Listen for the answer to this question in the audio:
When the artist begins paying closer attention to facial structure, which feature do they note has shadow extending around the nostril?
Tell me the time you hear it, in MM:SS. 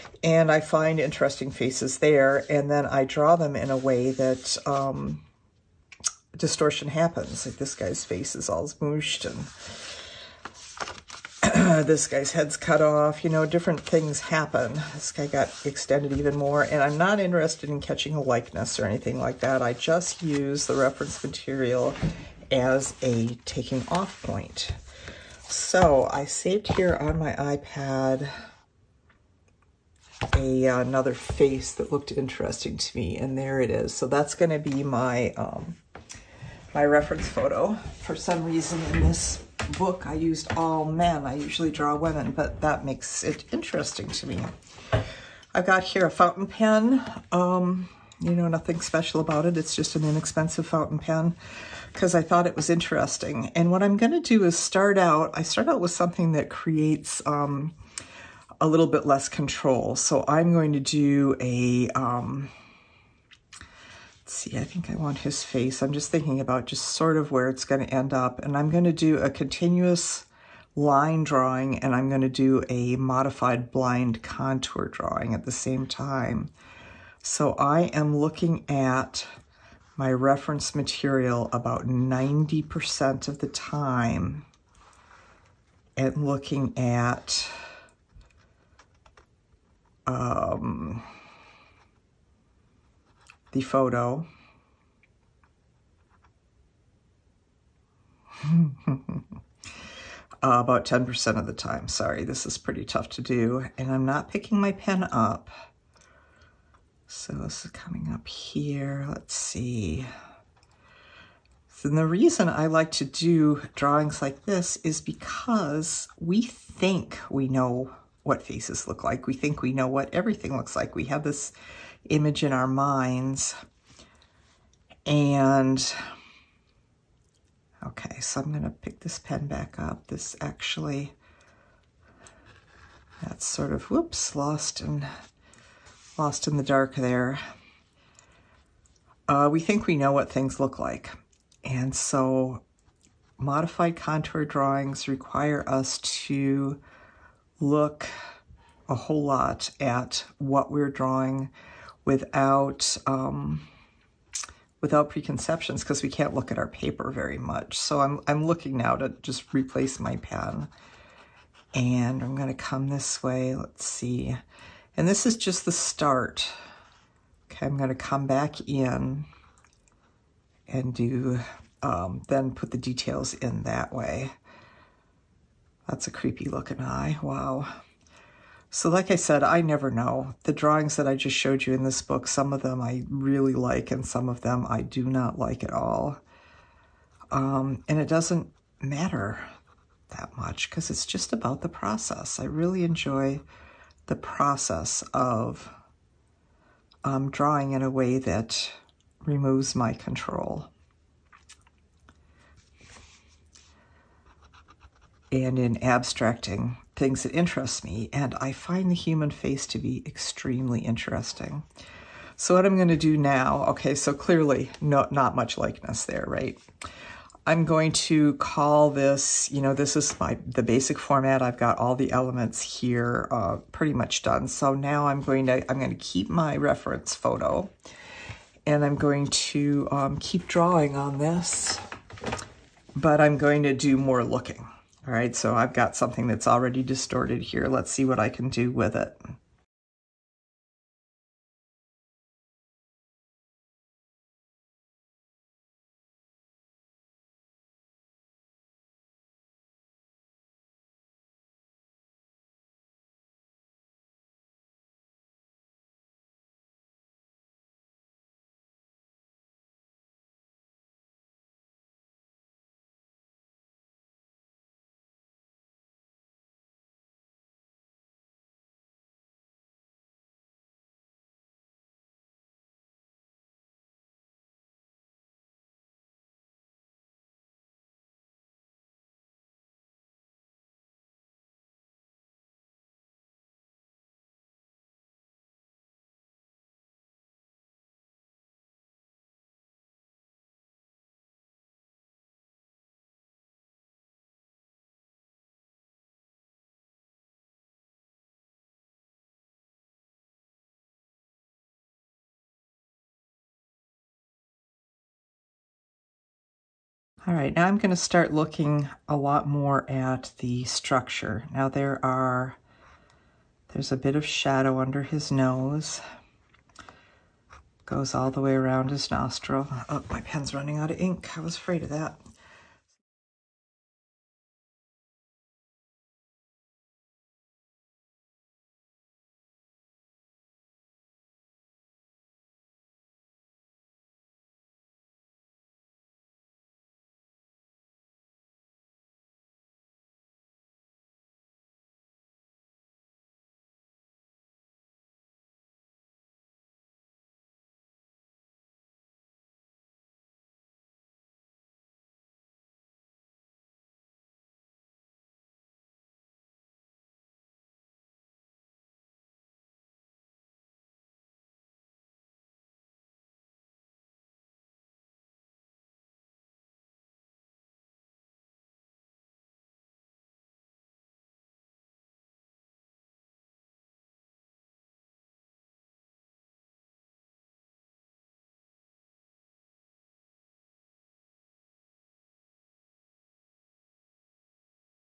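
05:15.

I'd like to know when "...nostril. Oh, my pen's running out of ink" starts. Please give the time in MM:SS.
05:19.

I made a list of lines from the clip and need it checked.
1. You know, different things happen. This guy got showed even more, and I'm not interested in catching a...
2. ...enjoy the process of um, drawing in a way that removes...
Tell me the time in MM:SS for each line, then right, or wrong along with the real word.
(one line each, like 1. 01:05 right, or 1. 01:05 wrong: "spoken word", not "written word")
1. 00:13 wrong: "extended", not "showed"
2. 03:12 right.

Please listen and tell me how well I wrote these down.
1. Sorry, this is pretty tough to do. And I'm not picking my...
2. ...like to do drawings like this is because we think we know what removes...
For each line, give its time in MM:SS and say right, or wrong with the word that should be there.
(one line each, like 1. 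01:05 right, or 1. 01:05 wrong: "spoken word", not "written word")
1. 01:41 right
2. 01:52 wrong: "faces", not "removes".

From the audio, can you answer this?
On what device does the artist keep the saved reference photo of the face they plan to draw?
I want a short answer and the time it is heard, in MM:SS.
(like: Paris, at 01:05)
iPad, at 00:27.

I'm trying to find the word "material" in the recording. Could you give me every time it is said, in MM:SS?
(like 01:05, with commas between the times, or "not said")
00:21, 01:20.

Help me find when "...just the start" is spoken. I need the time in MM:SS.
02:45.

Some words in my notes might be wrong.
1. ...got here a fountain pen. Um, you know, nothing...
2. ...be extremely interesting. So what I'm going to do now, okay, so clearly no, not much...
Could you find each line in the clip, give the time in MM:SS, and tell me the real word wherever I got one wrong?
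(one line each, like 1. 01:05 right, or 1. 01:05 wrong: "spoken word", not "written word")
1. 00:45 right
2. 03:29 right.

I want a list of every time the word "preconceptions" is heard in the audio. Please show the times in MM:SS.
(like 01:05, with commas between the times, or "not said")
02:35.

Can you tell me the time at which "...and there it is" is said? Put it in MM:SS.
00:33.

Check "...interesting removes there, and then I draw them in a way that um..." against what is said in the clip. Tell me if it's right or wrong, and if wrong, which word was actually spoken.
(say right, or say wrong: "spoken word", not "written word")
wrong: "faces", not "removes".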